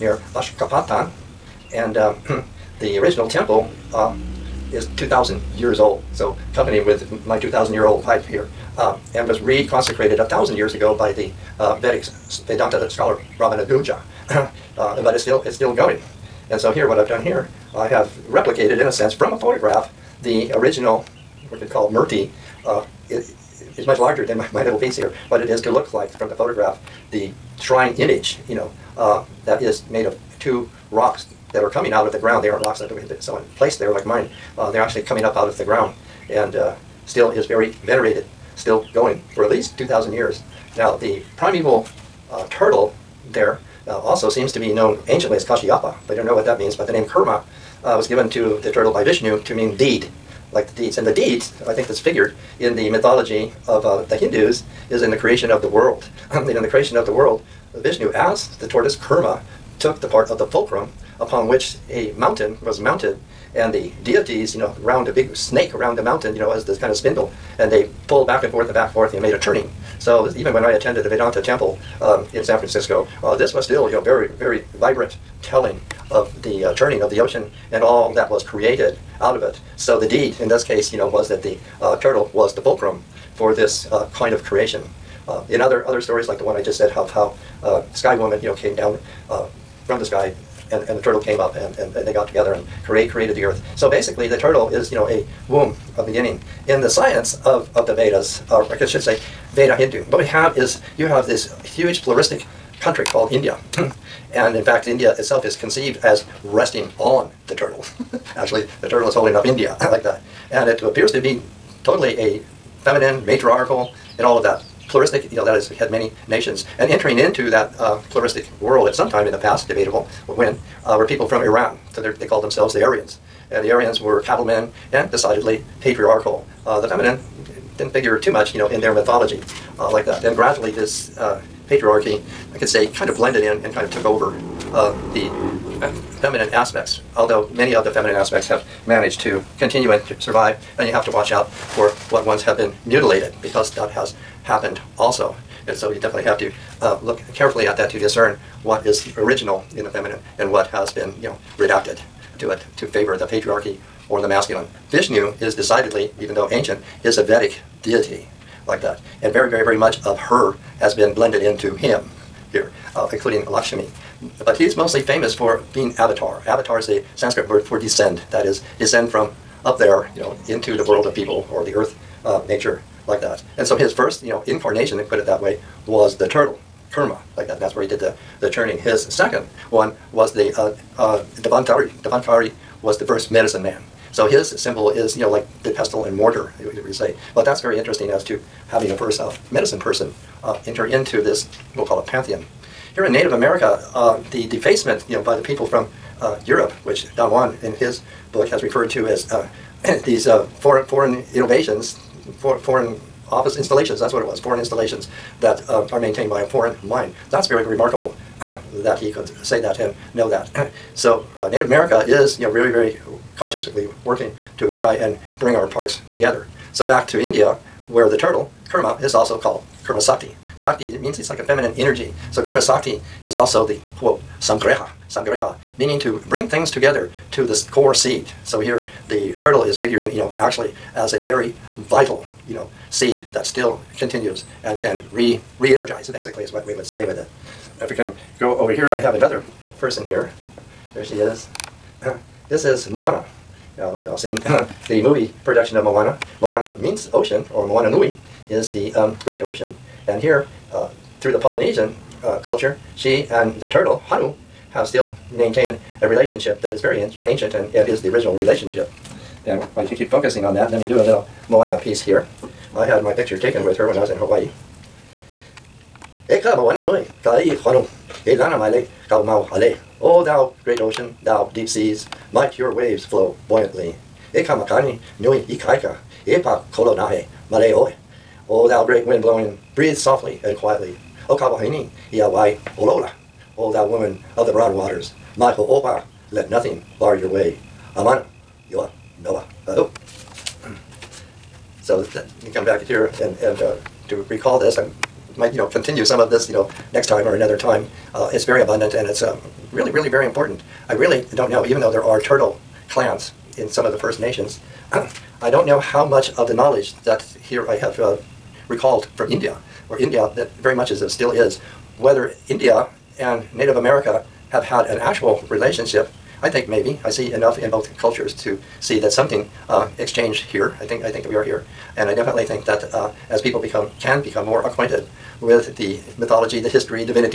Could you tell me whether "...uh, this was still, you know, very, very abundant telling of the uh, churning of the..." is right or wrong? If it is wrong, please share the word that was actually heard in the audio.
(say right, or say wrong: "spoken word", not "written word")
wrong: "vibrant", not "abundant".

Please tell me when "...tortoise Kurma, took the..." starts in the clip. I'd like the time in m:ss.
0:58.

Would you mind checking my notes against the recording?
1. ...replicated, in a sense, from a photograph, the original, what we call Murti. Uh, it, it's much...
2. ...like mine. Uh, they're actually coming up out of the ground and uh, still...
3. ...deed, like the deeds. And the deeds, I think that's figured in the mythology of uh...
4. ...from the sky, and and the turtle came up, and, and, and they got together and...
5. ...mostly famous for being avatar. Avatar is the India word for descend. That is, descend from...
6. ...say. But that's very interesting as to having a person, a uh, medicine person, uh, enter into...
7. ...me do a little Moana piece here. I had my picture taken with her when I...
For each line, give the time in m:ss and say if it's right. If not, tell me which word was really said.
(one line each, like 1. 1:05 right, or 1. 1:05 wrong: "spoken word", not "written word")
1. 0:18 right
2. 0:33 right
3. 0:49 right
4. 1:29 right
5. 2:44 wrong: "Sanskrit", not "India"
6. 3:06 right
7. 4:20 right.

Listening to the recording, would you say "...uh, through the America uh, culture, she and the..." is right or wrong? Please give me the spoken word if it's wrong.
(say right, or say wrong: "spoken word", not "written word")
wrong: "Polynesian", not "America".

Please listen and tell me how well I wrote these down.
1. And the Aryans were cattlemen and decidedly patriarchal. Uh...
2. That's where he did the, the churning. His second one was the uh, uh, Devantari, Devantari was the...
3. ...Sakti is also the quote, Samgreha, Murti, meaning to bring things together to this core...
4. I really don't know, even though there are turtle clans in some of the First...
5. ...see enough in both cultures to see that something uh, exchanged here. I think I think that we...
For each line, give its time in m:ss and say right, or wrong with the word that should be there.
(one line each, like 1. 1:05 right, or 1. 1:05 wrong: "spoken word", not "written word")
1. 2:03 right
2. 2:57 right
3. 3:42 wrong: "Samgreha", not "Murti"
4. 5:00 right
5. 5:17 right.